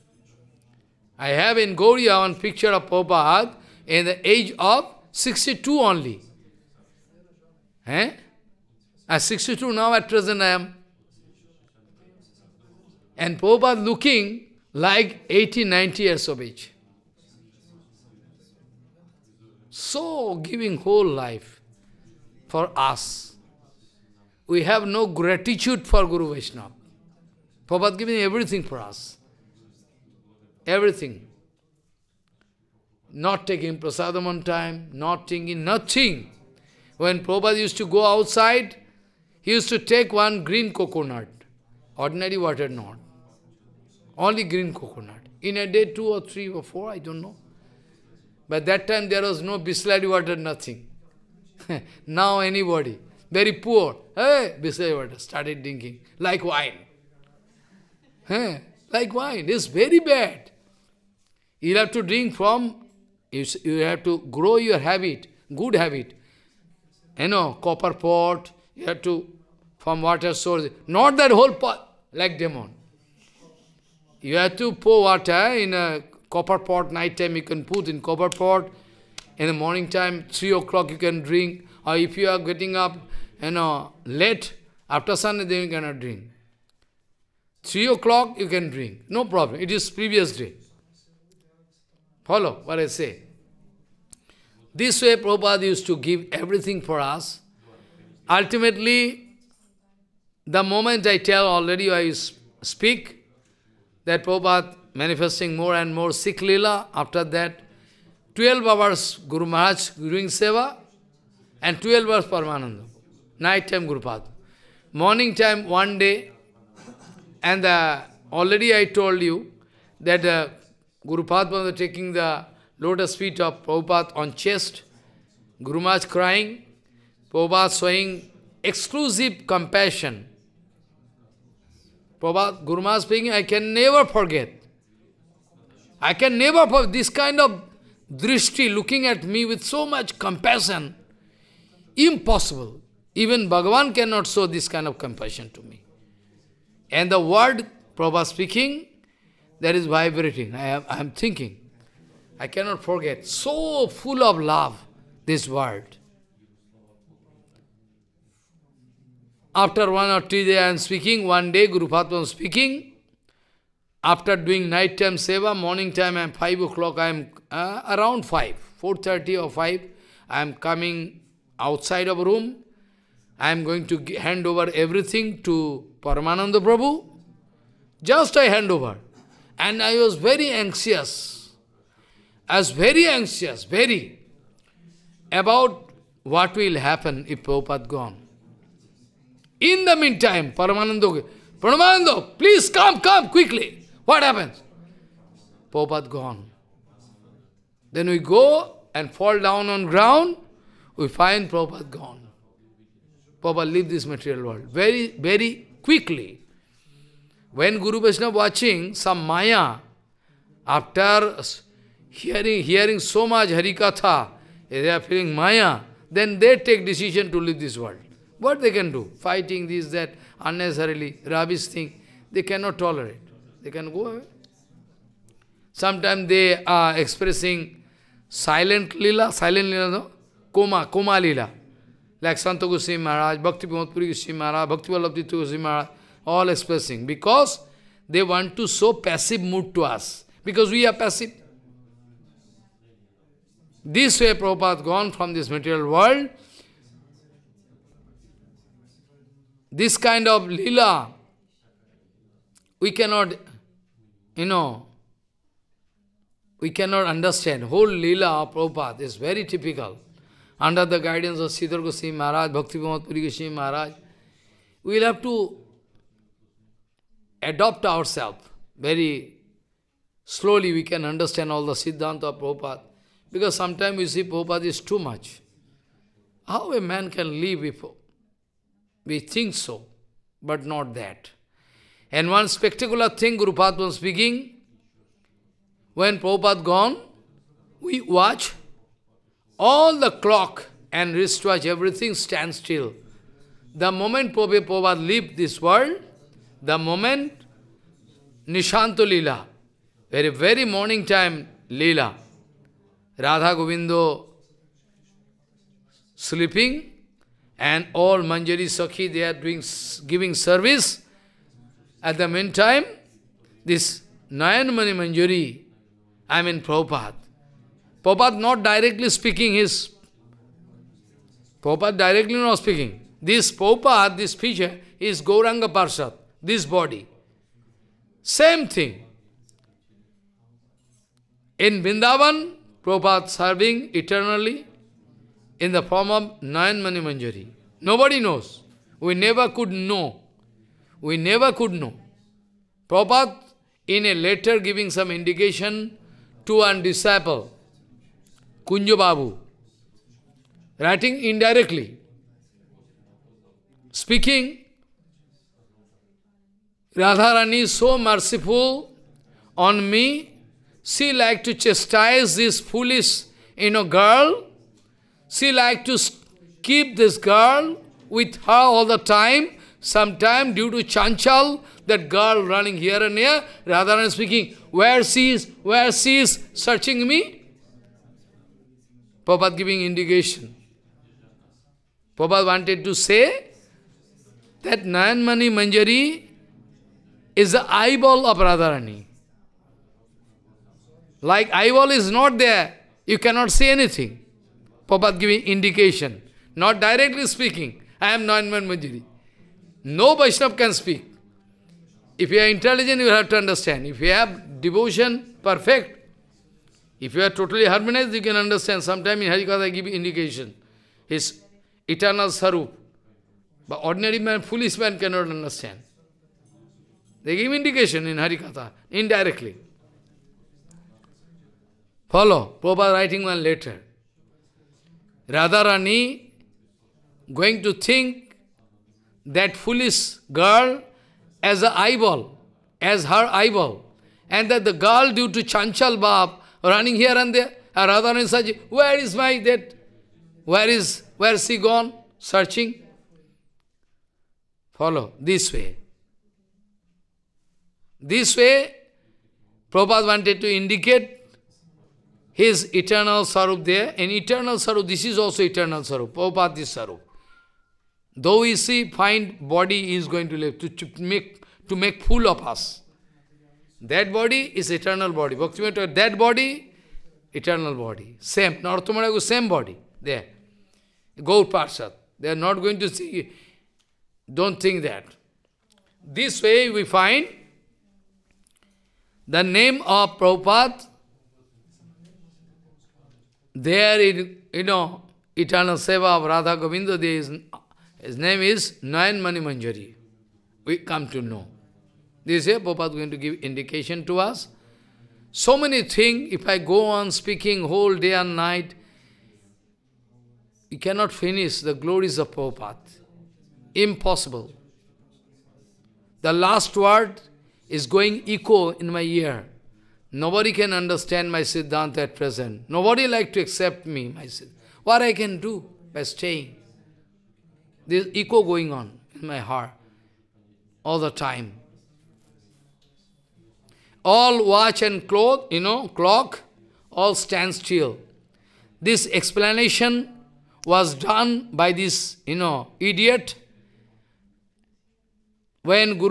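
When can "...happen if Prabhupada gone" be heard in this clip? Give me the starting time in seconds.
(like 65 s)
186 s.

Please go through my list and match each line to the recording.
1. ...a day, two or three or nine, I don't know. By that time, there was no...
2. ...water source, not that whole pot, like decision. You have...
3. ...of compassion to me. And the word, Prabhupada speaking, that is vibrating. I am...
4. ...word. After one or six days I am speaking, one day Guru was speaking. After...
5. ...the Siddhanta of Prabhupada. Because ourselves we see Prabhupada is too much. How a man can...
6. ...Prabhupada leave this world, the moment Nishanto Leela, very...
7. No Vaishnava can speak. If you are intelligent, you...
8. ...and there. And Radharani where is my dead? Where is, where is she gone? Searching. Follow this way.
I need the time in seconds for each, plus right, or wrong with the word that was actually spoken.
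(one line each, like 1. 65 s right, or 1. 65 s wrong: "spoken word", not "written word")
1. 45 s wrong: "four", not "nine"
2. 70 s wrong: "demon", not "decision"
3. 144 s right
4. 155 s wrong: "two", not "six"
5. 271 s wrong: "sometimes", not "ourselves"
6. 294 s right
7. 399 s right
8. 437 s right.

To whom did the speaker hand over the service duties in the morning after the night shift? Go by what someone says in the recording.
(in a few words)
Paramananda Prabhu.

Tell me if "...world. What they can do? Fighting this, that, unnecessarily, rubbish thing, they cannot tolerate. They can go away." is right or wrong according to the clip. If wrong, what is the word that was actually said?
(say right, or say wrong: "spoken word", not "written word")
right.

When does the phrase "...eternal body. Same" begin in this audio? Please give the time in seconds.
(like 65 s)
467 s.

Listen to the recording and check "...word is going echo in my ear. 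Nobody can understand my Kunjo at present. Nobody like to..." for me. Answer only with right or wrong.
wrong.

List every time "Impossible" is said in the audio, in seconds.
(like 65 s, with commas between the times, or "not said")
141 s, 503 s.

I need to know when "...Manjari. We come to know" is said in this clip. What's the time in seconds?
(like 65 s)
489 s.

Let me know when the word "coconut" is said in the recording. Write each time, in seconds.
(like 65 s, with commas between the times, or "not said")
40 s, 44 s.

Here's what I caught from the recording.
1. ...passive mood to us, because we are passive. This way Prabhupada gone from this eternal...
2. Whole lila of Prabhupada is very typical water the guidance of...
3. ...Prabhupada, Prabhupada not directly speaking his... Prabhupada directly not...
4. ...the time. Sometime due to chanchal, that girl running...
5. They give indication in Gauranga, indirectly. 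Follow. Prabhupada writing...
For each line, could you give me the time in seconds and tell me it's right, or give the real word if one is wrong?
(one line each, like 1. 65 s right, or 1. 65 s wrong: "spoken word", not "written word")
1. 238 s wrong: "material", not "eternal"
2. 257 s wrong: "under", not "water"
3. 316 s right
4. 368 s right
5. 417 s wrong: "Harikatha", not "Gauranga".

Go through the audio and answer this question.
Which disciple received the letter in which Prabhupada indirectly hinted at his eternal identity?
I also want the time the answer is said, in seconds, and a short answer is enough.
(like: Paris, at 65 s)
Kunjo Babu, at 348 s.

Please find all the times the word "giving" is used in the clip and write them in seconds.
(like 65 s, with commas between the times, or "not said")
20 s, 27 s, 310 s, 344 s, 379 s, 395 s.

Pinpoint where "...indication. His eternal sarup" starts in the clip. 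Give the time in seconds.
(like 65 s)
409 s.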